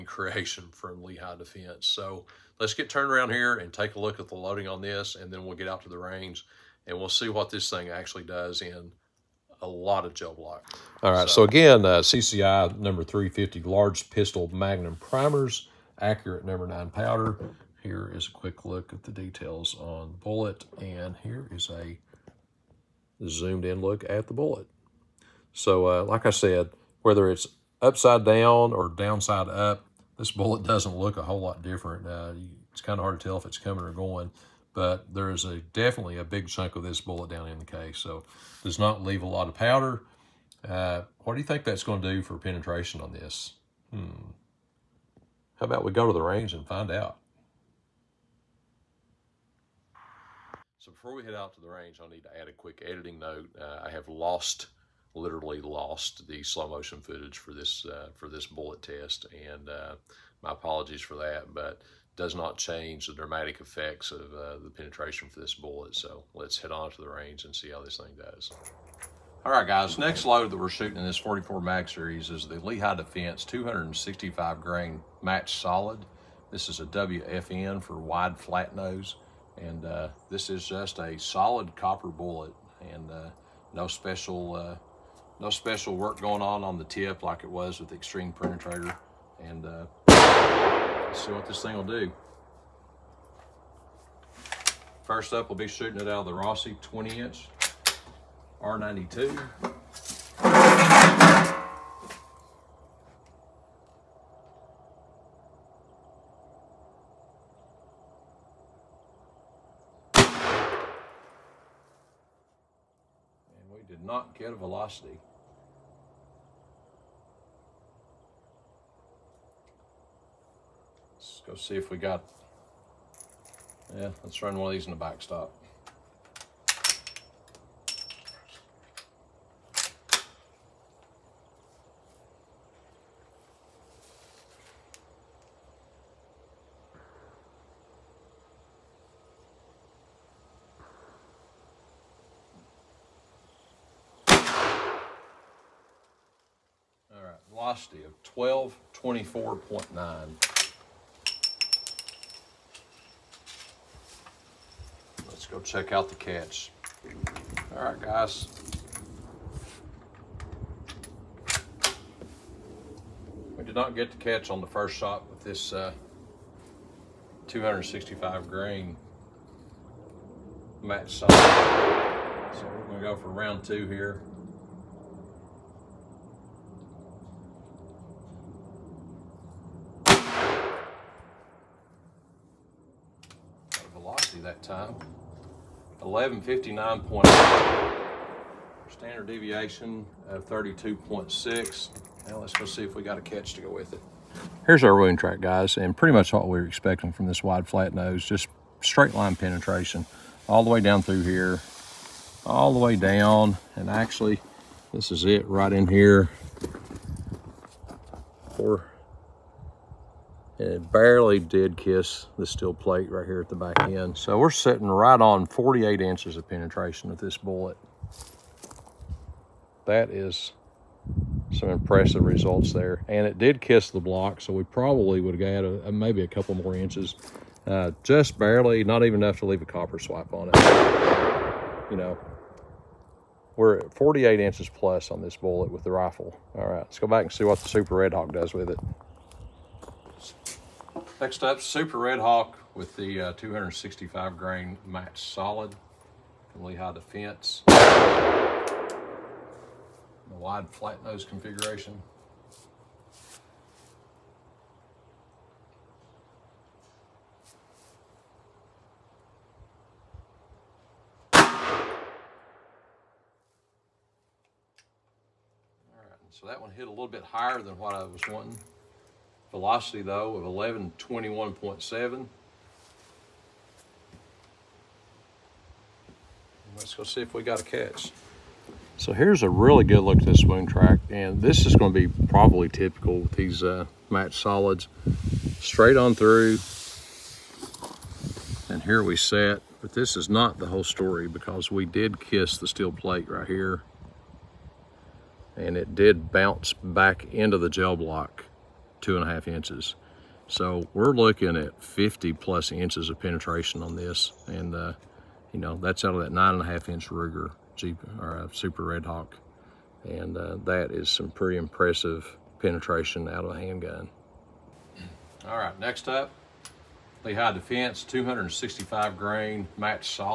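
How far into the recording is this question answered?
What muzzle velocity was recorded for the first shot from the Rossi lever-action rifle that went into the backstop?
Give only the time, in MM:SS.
02:29.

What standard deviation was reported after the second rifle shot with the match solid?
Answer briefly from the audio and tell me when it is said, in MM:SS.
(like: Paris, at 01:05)
32.6, at 03:10.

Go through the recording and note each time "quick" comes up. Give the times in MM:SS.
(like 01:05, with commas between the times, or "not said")
00:18, 00:52.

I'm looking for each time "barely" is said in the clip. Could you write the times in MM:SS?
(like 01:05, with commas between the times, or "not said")
03:30, 03:48.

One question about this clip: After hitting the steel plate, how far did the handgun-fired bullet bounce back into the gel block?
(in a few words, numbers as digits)
2.5 inches.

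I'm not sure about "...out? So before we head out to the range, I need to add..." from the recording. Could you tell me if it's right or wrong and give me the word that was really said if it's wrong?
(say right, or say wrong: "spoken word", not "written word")
right.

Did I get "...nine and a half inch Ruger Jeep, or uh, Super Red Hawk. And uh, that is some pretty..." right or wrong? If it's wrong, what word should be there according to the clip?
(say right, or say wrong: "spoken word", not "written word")
right.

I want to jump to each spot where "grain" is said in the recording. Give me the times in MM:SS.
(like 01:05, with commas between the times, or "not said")
01:14, 02:48, 04:04, 05:19.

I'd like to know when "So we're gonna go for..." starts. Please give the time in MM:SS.
02:52.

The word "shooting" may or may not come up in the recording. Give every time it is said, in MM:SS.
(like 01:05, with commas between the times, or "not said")
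01:10, 01:35.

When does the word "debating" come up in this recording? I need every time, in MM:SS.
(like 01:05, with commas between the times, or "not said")
not said.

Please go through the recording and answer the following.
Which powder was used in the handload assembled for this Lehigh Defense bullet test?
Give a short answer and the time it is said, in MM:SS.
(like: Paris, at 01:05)
Accurate No. 9, at 00:15.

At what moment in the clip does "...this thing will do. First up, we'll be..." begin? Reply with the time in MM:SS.
01:31.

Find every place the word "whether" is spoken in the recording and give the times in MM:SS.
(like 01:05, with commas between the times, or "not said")
00:27.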